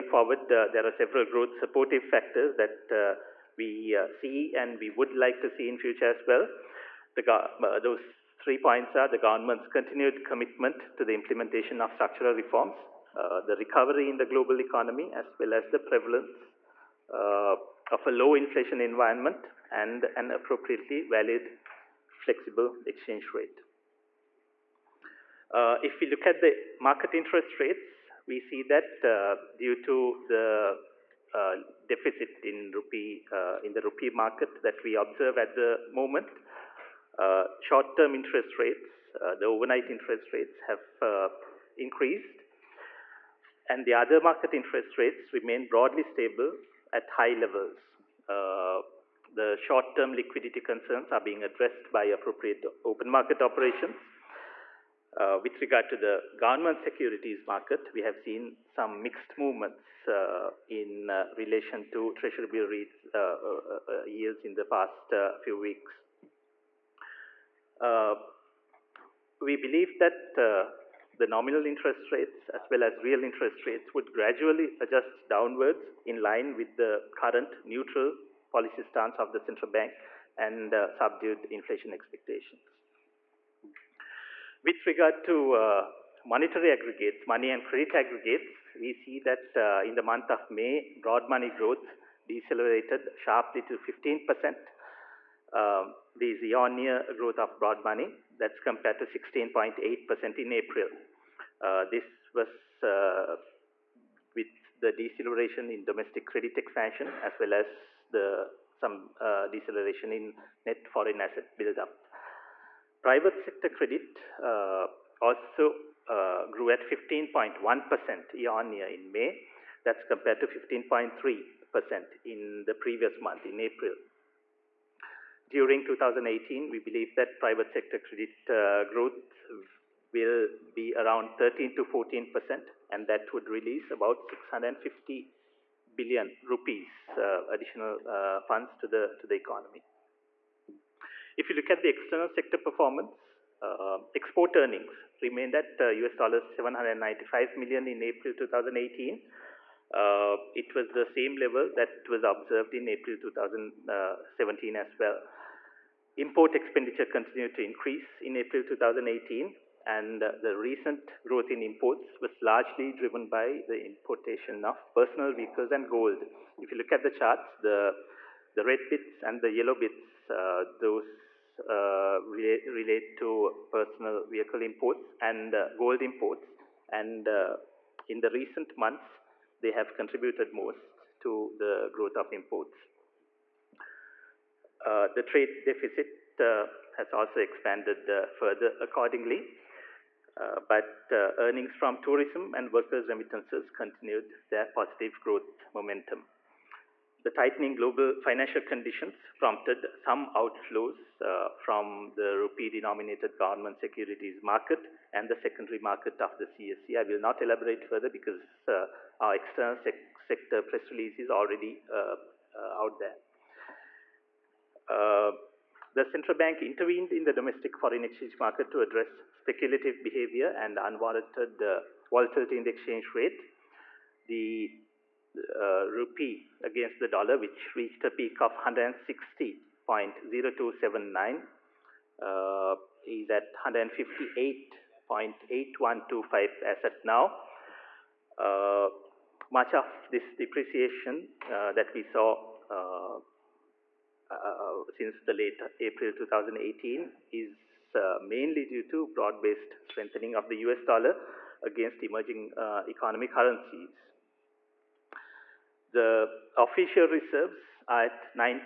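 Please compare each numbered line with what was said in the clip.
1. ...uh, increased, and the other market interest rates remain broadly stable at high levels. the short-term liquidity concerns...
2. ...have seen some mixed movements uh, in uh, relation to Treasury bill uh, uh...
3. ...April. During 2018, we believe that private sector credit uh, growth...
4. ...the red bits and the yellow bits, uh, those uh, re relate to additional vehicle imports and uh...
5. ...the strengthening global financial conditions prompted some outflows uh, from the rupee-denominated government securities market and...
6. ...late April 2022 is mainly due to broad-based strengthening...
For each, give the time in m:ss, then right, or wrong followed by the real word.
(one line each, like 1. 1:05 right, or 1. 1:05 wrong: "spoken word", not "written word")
1. 0:41 right
2. 0:58 right
3. 2:03 right
4. 2:48 wrong: "personal", not "additional"
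5. 3:17 wrong: "tightening", not "strengthening"
6. 4:05 wrong: "2018", not "2022".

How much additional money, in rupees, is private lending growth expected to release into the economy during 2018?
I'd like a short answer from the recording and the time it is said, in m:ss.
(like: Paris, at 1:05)
650 billion rupees, at 2:14.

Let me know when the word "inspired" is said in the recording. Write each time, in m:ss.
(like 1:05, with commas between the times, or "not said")
not said.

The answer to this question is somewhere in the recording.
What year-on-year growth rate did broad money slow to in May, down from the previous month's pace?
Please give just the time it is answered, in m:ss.
1:33.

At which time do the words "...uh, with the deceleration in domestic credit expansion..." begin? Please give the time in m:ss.
1:42.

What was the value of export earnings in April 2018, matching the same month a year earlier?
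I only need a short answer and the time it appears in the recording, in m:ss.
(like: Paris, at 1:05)
US$795 million, at 2:25.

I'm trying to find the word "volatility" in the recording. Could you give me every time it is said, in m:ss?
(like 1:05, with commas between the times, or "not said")
3:42.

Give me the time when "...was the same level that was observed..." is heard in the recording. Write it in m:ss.
2:30.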